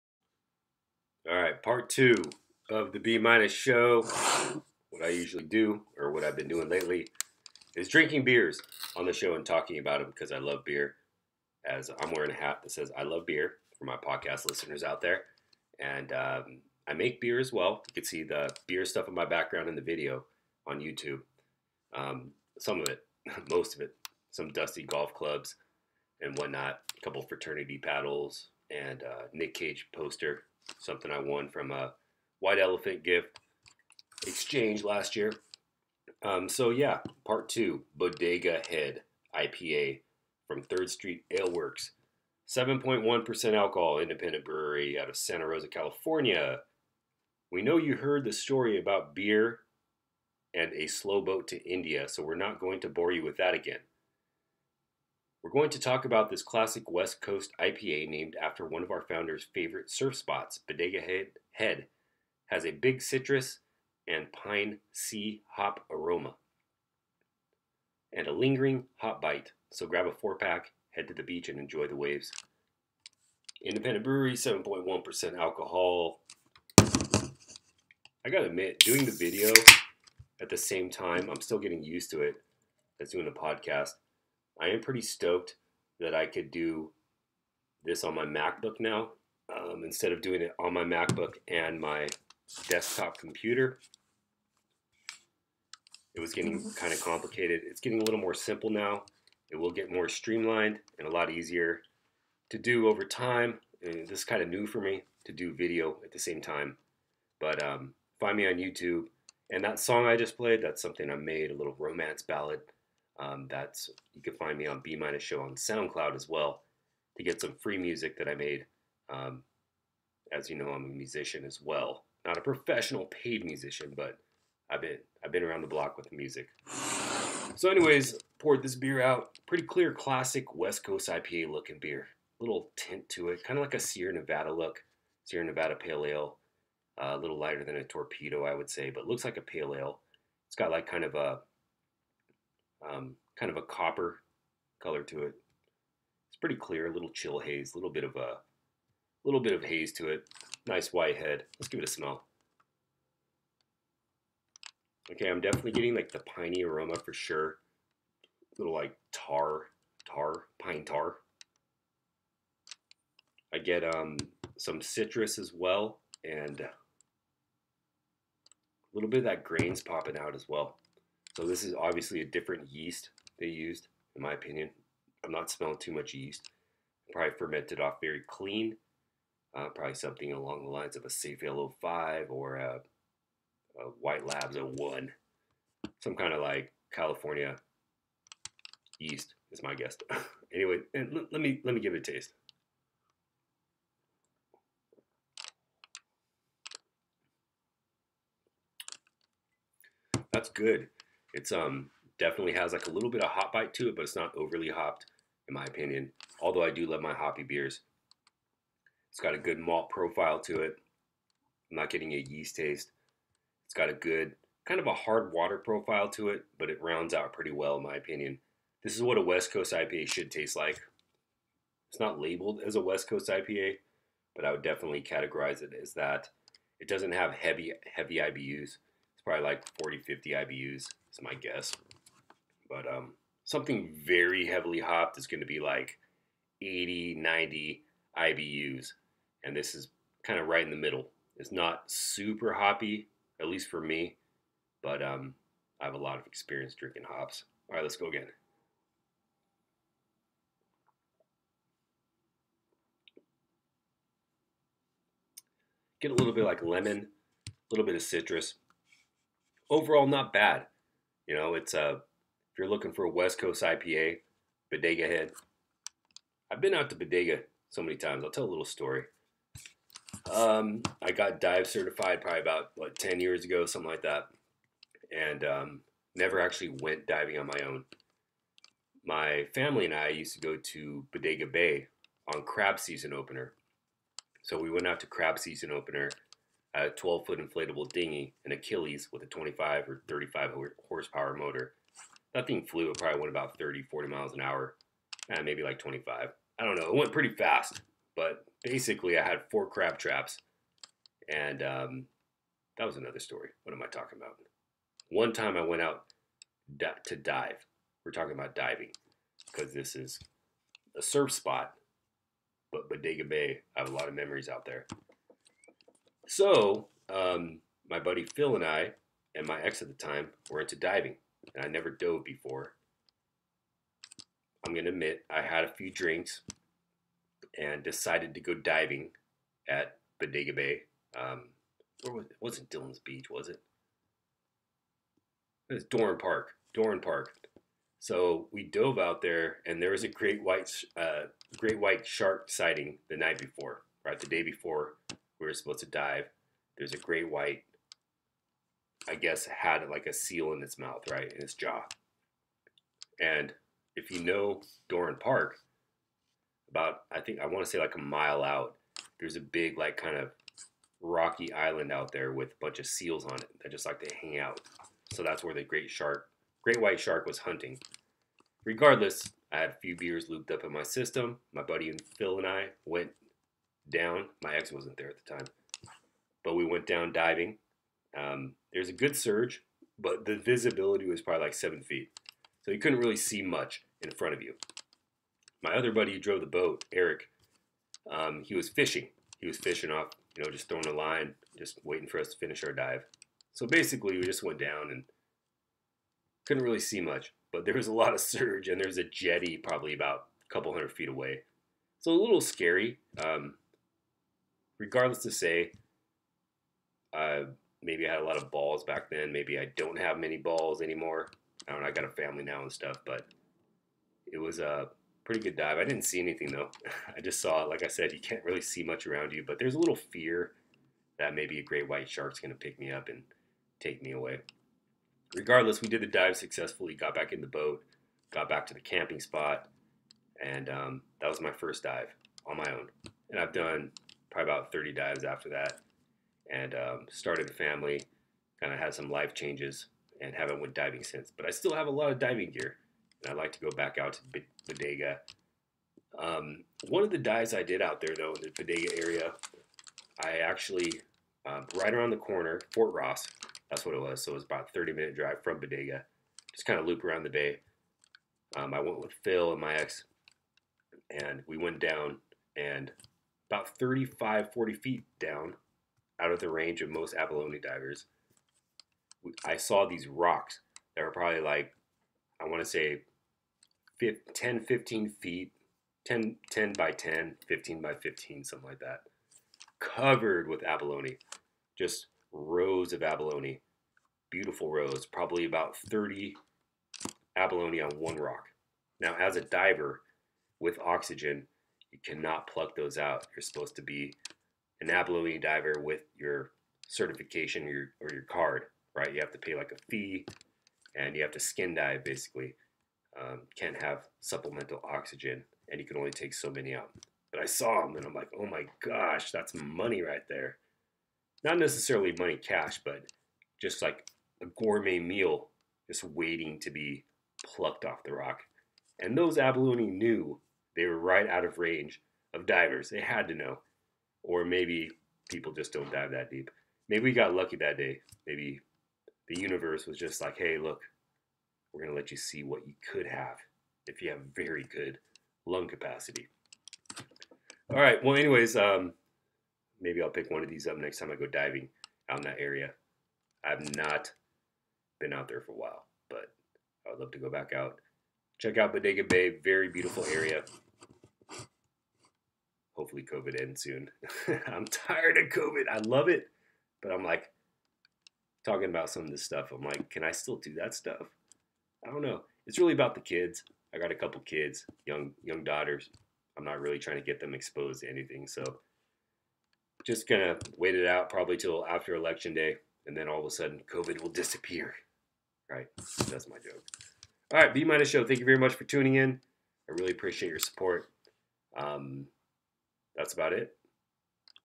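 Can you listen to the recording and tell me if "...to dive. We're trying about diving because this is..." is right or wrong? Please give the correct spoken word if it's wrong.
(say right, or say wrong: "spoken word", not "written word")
wrong: "talking", not "trying".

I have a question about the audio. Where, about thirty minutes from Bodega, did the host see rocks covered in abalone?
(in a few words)
Fort Ross.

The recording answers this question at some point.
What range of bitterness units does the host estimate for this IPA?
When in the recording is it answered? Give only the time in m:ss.
3:49.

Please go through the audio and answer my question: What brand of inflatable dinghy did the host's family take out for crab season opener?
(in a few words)
Achilles.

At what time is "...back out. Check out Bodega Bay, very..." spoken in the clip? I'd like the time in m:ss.
9:07.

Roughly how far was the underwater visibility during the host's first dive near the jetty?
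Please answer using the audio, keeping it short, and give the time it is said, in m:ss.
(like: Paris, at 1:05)
7 feet, at 6:21.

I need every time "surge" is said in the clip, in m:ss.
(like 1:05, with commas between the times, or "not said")
6:19, 6:38.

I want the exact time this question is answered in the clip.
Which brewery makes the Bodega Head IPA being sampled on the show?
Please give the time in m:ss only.
0:40.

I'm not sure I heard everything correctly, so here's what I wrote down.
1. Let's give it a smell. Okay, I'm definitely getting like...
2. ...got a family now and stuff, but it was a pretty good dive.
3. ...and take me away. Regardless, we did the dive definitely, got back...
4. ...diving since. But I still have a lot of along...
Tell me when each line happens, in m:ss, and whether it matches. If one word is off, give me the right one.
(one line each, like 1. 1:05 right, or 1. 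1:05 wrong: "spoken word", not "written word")
1. 2:31 right
2. 6:51 right
3. 7:03 wrong: "successfully", not "definitely"
4. 7:20 wrong: "diving", not "along".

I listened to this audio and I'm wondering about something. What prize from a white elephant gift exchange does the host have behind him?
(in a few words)
Nick Cage poster.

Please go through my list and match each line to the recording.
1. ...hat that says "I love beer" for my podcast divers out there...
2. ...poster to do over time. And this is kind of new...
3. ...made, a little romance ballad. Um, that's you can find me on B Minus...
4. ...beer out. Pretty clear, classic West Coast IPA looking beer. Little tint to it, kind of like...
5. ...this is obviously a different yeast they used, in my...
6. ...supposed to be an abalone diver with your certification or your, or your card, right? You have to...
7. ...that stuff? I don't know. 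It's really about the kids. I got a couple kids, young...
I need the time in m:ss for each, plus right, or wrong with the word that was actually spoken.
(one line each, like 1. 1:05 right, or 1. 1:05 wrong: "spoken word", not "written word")
1. 0:12 wrong: "listeners", not "divers"
2. 1:41 wrong: "easier", not "poster"
3. 1:51 right
4. 2:08 right
5. 2:51 right
6. 8:13 right
7. 9:20 right.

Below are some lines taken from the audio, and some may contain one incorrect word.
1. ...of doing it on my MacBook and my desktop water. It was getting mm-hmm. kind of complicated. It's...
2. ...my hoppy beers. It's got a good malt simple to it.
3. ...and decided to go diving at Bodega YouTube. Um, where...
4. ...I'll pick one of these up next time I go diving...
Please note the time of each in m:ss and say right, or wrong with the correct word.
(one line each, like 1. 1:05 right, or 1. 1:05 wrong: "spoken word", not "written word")
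1. 1:30 wrong: "computer", not "water"
2. 3:27 wrong: "profile", not "simple"
3. 5:27 wrong: "Bay", not "YouTube"
4. 9:00 right.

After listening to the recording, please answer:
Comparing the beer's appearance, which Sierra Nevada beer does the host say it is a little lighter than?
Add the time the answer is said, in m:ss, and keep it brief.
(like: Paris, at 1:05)
Torpedo, at 2:17.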